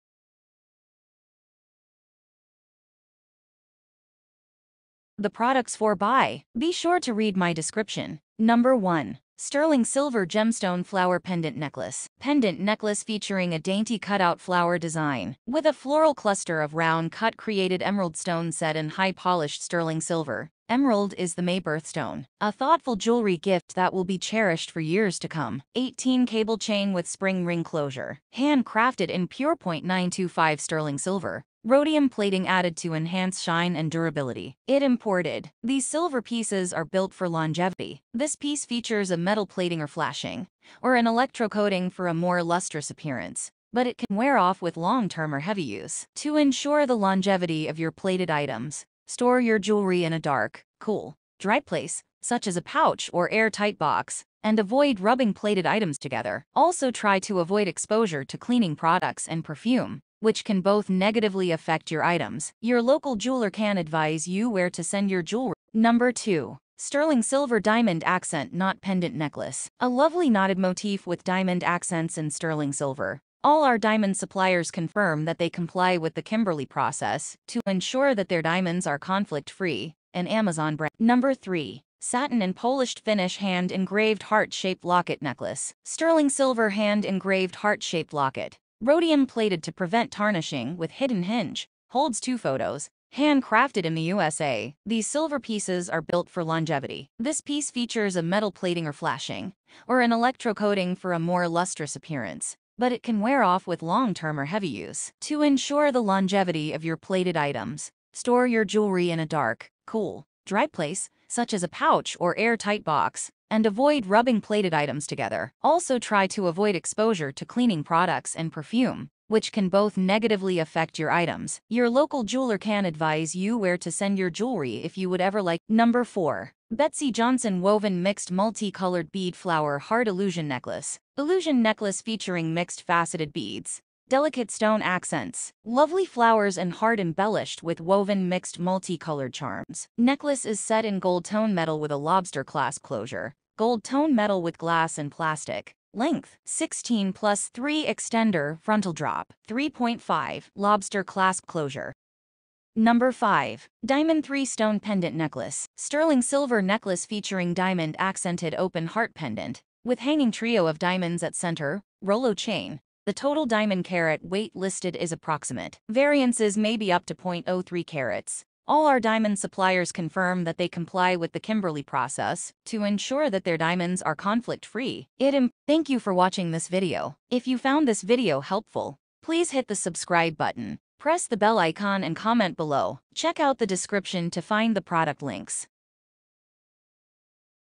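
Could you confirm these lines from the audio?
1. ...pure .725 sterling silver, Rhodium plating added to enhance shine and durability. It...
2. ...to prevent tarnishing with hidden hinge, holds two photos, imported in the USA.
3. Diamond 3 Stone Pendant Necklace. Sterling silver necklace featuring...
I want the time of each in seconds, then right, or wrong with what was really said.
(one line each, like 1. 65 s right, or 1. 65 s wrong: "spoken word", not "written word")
1. 29 s wrong: "925", not "725"
2. 89 s wrong: "handcrafted", not "imported"
3. 153 s right.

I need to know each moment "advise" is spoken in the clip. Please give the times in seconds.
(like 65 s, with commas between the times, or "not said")
63 s, 122 s.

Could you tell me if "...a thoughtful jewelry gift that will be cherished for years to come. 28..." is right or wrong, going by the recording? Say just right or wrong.
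wrong.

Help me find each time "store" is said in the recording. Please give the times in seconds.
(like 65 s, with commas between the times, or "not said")
49 s, 108 s.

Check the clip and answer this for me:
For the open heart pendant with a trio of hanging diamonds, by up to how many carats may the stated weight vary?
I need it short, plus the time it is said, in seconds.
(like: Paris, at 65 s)
0.03 carats, at 167 s.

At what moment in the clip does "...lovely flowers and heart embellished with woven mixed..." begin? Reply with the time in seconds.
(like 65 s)
135 s.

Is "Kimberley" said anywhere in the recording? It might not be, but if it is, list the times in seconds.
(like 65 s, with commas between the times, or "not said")
76 s, 171 s.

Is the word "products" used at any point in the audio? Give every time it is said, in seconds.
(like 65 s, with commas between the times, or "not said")
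5 s, 58 s, 117 s, 184 s.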